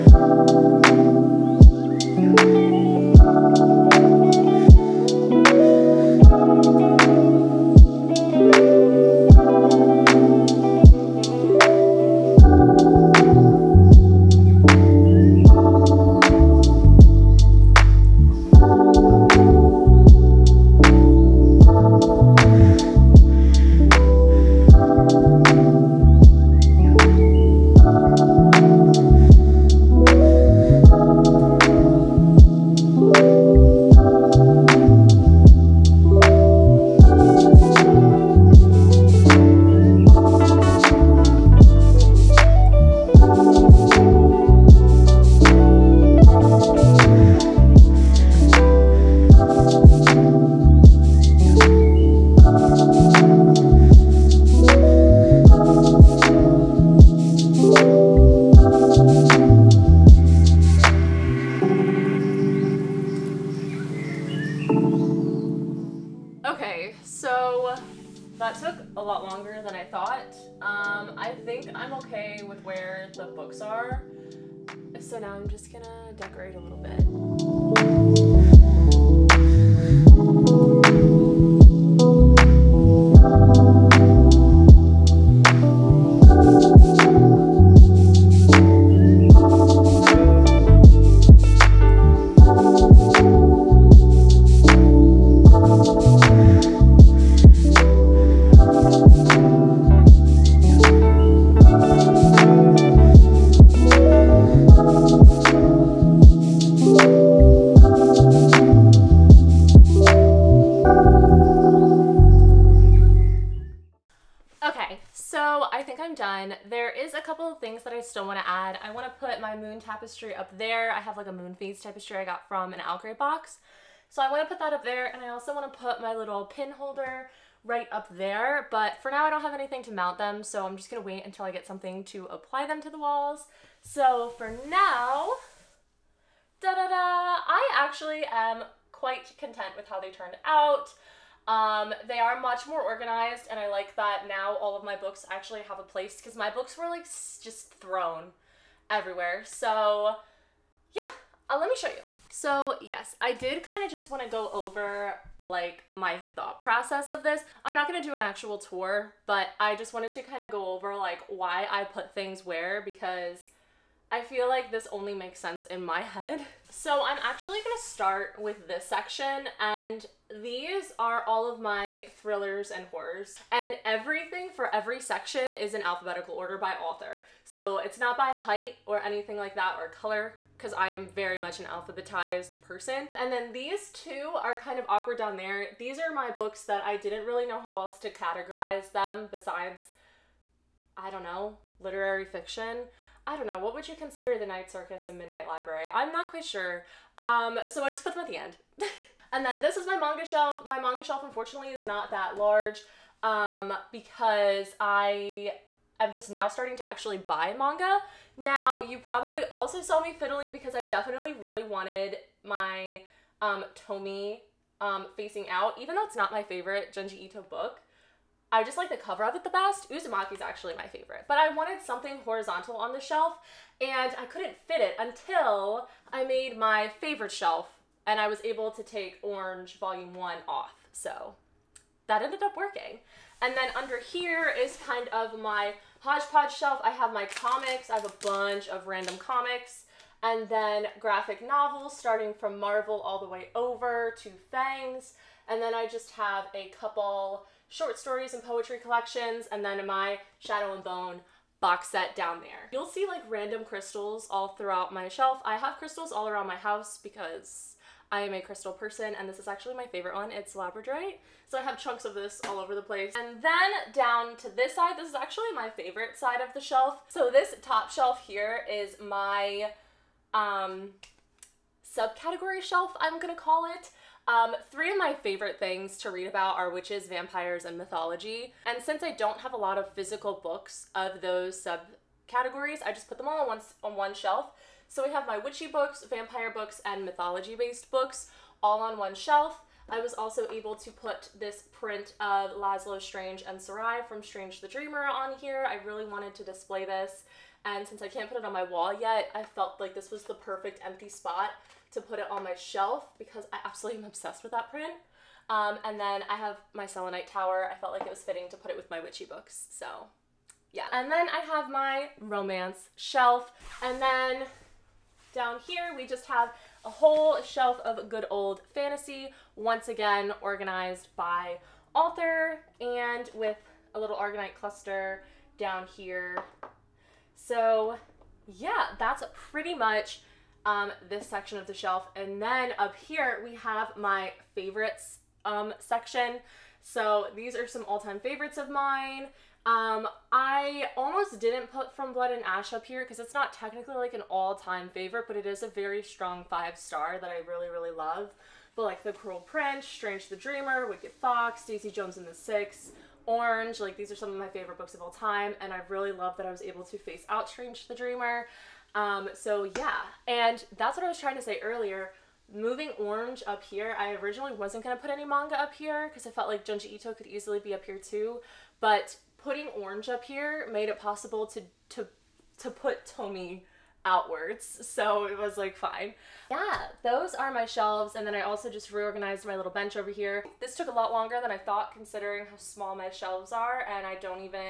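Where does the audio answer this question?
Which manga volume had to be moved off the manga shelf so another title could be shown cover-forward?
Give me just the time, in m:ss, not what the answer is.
3:49.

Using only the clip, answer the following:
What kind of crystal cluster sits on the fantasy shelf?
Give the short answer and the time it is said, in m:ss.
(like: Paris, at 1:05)
Aragonite, at 5:24.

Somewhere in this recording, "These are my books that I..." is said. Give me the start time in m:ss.
3:05.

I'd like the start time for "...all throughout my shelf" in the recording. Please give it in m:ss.
4:14.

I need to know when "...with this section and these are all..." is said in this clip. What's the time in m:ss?
2:48.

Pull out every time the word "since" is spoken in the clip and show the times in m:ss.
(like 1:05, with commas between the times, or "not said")
4:38, 4:57.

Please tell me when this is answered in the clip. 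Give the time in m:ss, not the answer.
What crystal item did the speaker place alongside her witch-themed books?
5:06.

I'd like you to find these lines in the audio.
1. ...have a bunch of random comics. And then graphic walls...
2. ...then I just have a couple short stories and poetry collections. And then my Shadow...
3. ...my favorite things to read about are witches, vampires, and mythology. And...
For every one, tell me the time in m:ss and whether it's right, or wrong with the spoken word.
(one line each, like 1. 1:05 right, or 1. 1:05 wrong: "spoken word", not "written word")
1. 3:57 wrong: "novels", not "walls"
2. 4:05 right
3. 4:34 right.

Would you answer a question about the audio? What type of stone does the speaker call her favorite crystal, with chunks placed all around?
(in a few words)
Labradorite.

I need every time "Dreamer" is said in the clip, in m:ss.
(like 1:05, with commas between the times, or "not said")
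4:54, 5:50, 5:57.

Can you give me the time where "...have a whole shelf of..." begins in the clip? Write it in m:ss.
5:16.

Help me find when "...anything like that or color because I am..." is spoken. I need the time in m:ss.
2:59.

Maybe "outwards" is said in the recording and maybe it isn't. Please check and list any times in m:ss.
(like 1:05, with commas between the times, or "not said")
6:14.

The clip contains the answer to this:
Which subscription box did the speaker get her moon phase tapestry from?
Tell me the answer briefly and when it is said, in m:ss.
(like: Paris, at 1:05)
Algrey box, at 2:02.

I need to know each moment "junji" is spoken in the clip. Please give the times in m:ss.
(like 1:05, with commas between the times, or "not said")
3:36, 6:06.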